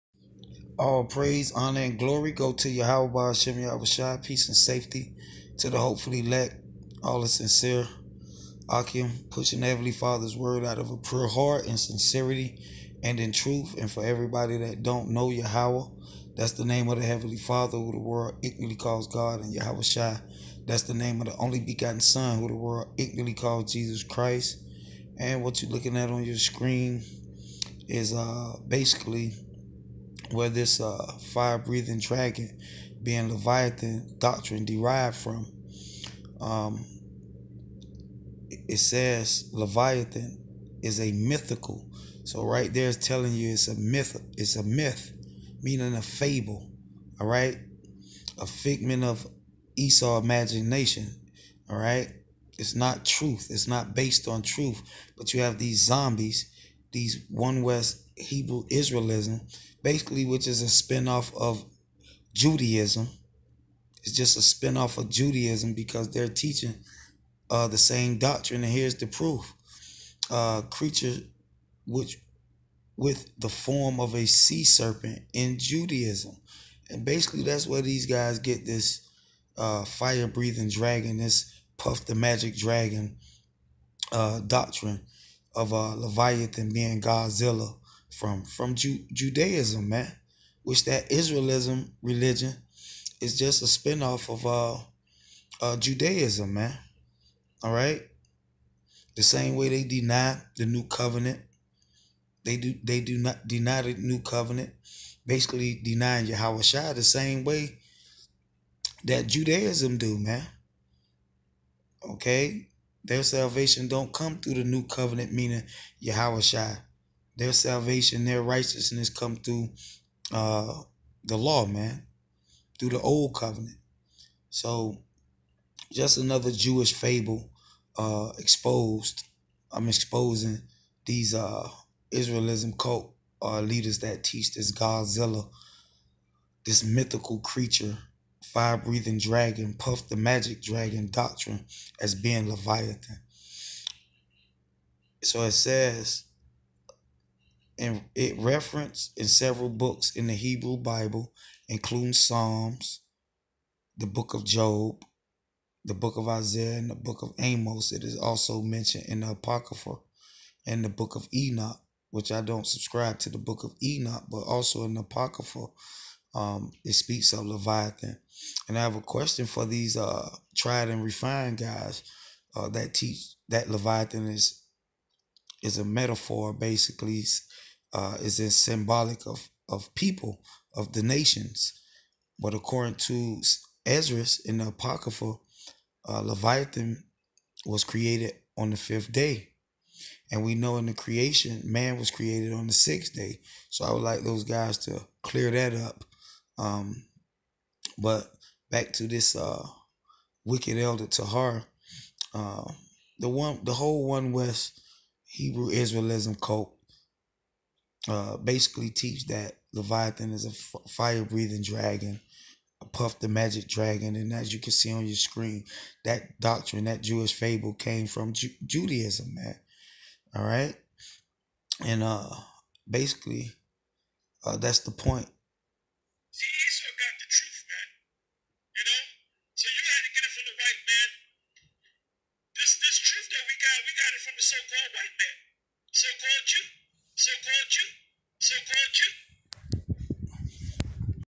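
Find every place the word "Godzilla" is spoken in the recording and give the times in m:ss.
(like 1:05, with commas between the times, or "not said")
1:27, 2:14.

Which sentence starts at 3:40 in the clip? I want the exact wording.
All right, and uh, basically, uh, that's the point got the truth, man.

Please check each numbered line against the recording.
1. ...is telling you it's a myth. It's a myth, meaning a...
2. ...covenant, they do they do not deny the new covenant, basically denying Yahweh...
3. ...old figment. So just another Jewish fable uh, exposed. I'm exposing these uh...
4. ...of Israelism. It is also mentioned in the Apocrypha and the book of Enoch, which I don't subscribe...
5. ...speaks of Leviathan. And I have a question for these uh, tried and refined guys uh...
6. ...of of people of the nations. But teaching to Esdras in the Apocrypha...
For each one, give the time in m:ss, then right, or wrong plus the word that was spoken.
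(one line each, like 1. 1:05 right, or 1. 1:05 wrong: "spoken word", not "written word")
1. 0:42 right
2. 1:40 right
3. 2:03 wrong: "covenant", not "figment"
4. 2:37 wrong: "Amos", not "Israelism"
5. 2:46 right
6. 2:59 wrong: "according", not "teaching".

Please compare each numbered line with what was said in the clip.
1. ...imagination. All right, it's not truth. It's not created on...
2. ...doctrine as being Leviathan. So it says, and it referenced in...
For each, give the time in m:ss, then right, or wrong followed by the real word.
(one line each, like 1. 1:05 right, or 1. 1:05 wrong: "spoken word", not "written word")
1. 0:50 wrong: "based", not "created"
2. 2:21 right.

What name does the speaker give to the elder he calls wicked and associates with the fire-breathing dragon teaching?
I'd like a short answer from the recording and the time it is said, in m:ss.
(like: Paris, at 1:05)
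Tahar, at 3:21.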